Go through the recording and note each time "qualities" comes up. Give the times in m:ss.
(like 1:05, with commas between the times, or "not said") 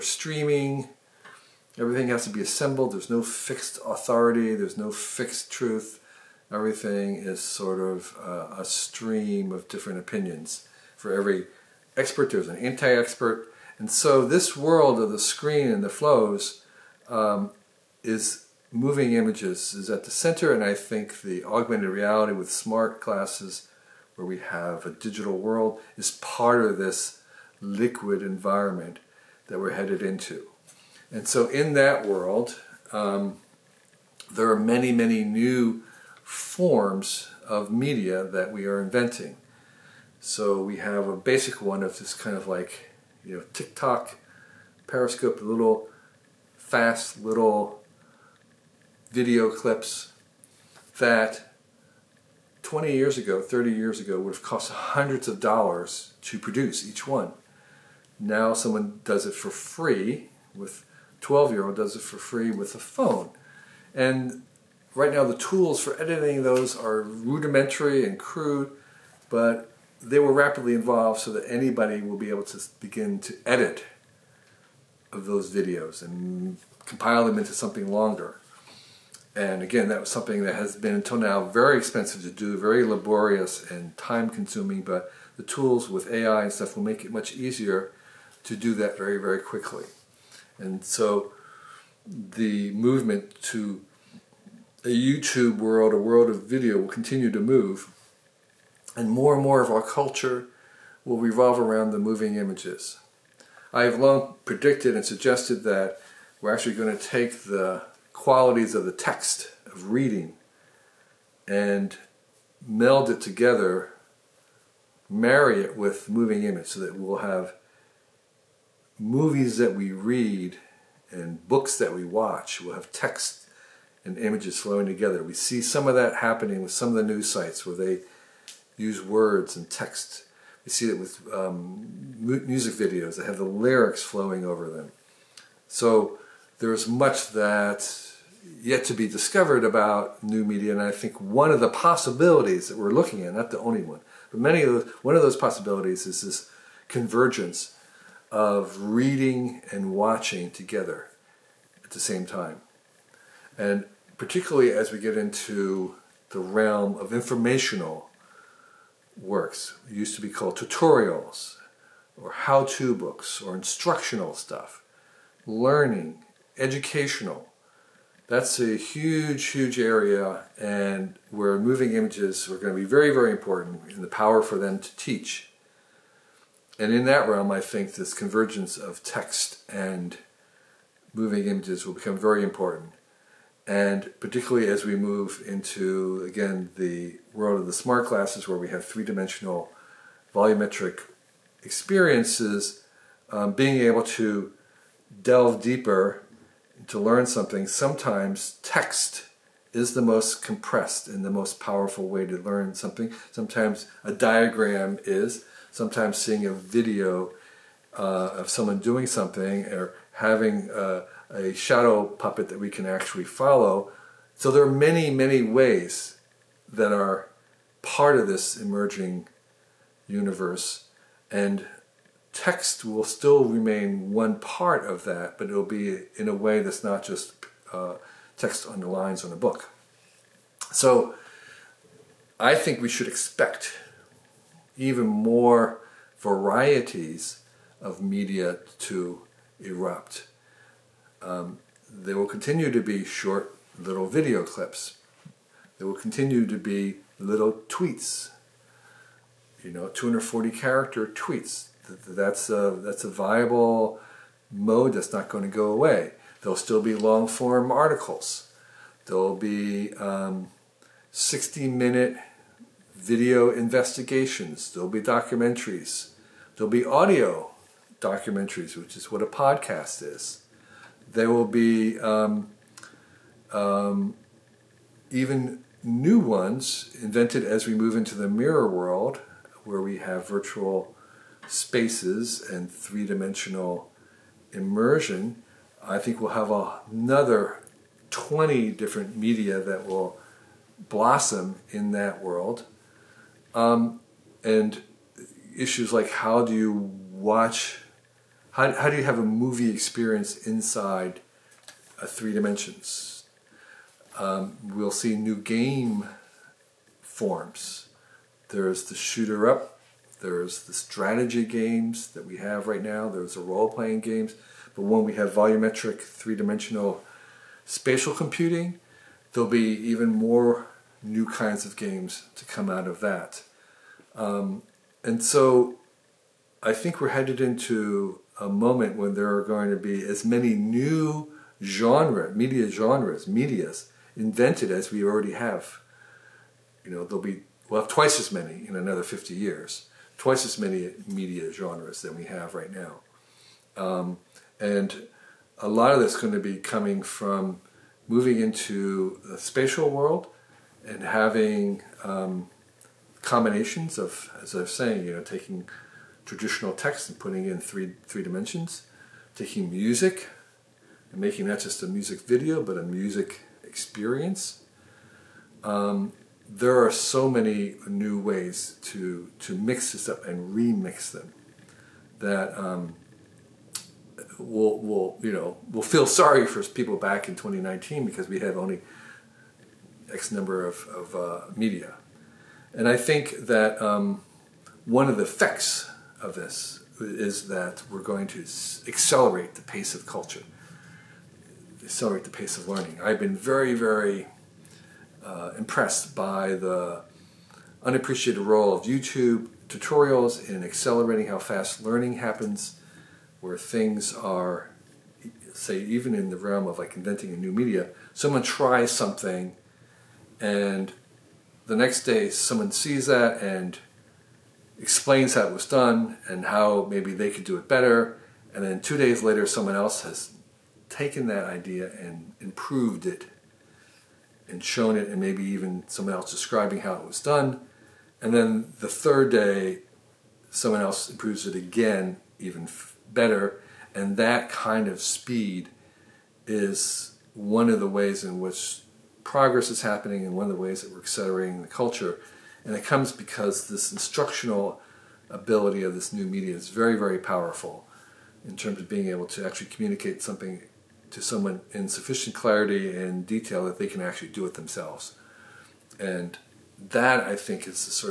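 1:48.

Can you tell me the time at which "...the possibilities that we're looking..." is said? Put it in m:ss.
2:21.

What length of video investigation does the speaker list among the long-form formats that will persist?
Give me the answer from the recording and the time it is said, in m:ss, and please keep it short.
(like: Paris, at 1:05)
60 minute, at 4:21.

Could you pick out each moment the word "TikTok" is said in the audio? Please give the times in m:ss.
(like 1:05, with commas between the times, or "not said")
0:43.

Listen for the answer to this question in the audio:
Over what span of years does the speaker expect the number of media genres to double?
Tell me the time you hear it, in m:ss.
5:39.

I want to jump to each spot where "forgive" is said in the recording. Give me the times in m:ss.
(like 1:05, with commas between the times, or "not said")
not said.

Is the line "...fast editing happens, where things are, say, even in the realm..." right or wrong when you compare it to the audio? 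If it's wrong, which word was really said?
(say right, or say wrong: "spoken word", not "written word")
wrong: "learning", not "editing".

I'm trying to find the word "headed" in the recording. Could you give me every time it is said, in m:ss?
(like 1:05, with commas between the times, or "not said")
0:29, 5:27.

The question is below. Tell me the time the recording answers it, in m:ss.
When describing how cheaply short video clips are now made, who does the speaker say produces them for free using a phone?
1:01.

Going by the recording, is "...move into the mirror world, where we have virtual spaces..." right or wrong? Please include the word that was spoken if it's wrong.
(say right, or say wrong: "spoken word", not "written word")
right.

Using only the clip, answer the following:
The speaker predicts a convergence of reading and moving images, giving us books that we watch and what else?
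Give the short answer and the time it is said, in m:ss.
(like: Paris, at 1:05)
movies that we read, at 1:58.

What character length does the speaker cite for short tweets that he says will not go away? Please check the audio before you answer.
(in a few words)
240.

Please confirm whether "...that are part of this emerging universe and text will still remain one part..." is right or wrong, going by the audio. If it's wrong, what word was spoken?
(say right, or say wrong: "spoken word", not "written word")
right.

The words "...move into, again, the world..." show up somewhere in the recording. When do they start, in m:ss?
3:04.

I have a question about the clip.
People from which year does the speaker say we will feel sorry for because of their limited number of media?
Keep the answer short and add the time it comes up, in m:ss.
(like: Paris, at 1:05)
2019, at 6:17.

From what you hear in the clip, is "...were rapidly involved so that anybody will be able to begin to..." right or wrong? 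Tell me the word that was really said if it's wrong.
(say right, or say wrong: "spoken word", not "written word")
right.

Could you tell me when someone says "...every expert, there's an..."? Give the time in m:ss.
0:11.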